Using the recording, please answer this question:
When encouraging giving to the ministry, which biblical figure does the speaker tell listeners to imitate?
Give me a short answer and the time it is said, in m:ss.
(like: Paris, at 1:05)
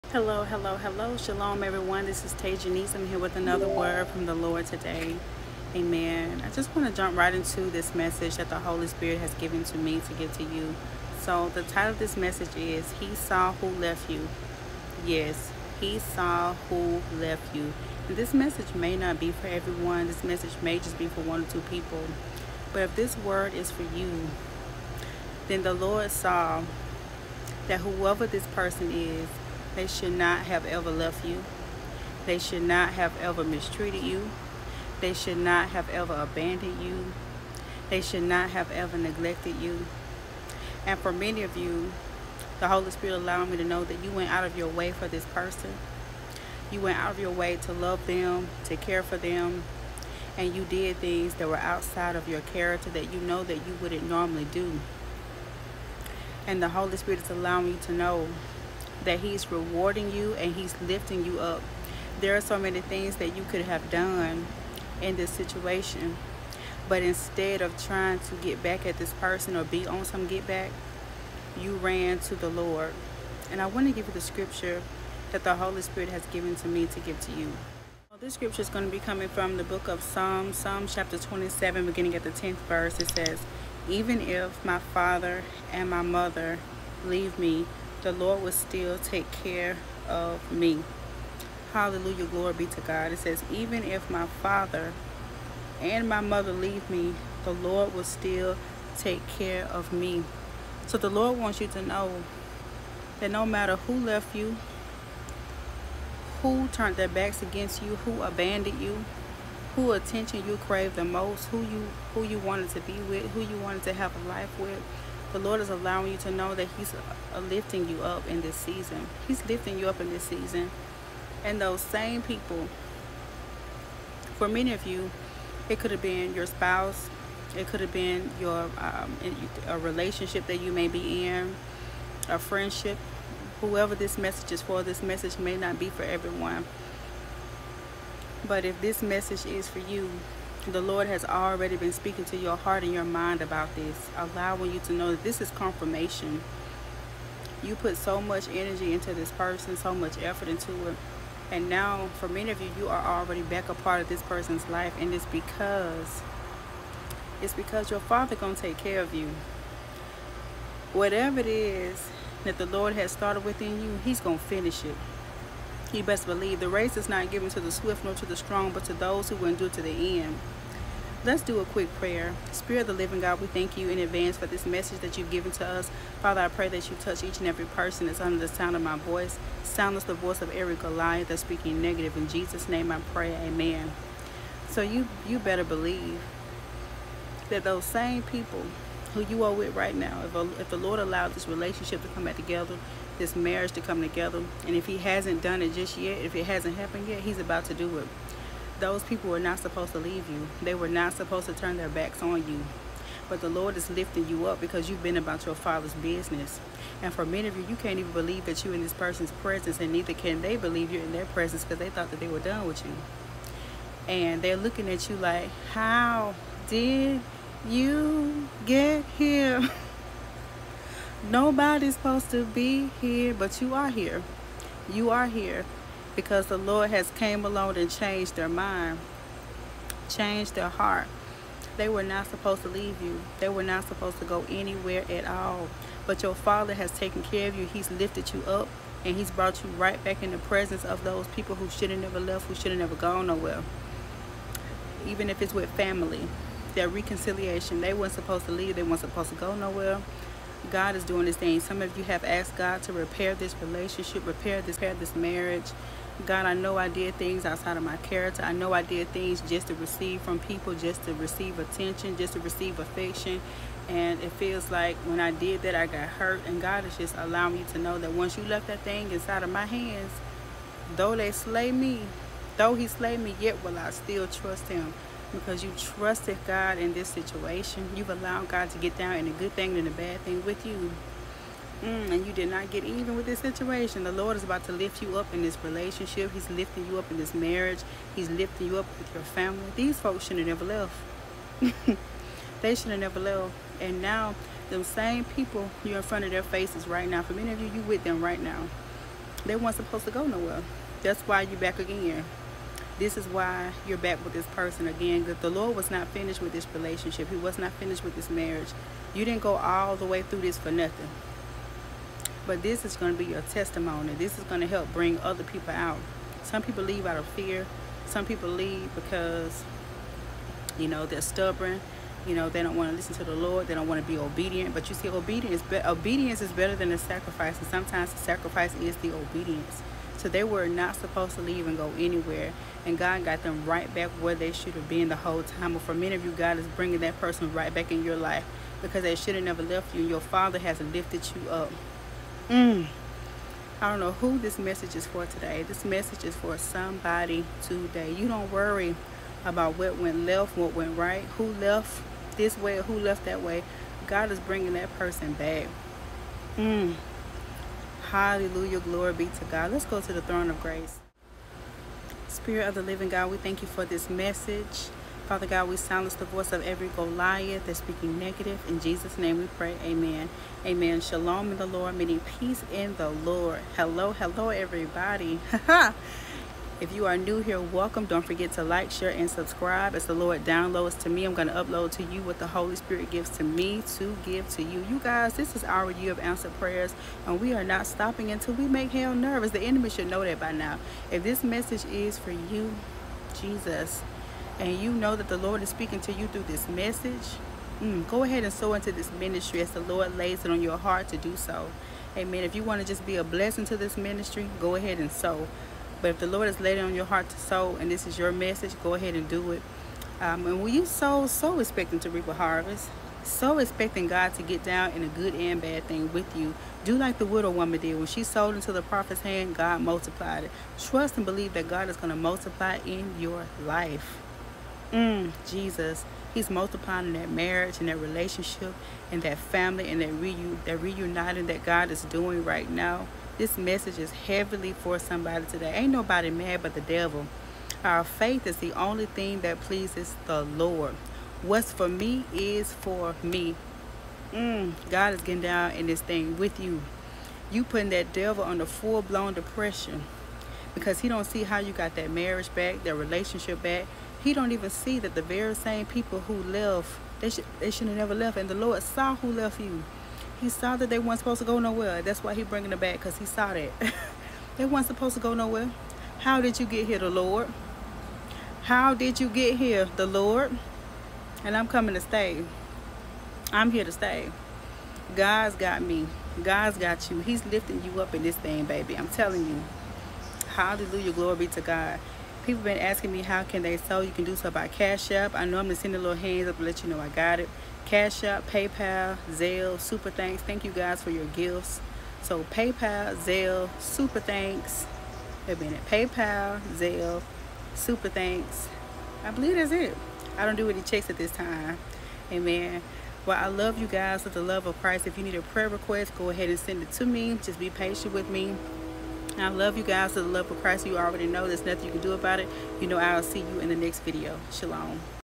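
the widow woman, at 6:57.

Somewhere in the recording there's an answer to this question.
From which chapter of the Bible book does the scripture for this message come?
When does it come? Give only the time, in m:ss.
1:20.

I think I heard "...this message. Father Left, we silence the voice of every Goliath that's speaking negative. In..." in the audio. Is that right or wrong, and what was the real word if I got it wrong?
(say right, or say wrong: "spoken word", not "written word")
wrong: "God", not "Left".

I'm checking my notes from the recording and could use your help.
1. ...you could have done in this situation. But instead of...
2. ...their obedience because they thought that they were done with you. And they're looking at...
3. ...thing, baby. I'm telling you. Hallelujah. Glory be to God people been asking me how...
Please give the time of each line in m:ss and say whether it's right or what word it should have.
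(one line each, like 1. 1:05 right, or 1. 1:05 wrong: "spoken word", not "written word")
1. 1:03 right
2. 3:31 wrong: "presence", not "obedience"
3. 7:58 right.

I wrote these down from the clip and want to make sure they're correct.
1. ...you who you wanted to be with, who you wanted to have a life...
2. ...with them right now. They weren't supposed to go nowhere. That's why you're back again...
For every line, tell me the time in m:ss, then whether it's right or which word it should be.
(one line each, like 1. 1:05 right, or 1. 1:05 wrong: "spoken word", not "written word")
1. 1:51 right
2. 4:57 right.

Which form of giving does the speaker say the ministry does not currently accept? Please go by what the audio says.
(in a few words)
checks.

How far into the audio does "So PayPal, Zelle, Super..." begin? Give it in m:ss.
8:12.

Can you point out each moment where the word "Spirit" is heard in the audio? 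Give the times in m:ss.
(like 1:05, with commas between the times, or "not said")
0:08, 0:42, 0:56, 1:15, 2:52, 6:02, 6:22.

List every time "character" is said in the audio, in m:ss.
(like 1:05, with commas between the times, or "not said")
0:52, 4:17.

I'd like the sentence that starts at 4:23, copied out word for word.
And it feels like when I did that, I got hurt.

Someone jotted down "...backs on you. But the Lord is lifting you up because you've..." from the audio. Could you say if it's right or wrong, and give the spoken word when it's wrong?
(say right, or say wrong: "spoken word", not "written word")
right.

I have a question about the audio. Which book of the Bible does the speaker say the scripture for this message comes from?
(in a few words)
Psalms.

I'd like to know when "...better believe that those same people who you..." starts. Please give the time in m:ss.
3:05.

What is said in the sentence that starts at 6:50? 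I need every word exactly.
Um, and when you sow, sow expecting to reap a harvest.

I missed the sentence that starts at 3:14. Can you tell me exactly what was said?
And if he hasn't done it just yet, if it hasn't happened yet, he's about to do it.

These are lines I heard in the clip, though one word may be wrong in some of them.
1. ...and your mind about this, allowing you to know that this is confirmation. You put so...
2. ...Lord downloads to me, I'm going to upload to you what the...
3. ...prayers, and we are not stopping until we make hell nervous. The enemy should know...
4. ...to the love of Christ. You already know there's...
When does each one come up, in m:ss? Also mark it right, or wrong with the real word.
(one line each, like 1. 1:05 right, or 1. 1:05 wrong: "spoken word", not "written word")
1. 2:22 right
2. 6:20 right
3. 6:26 right
4. 8:30 right.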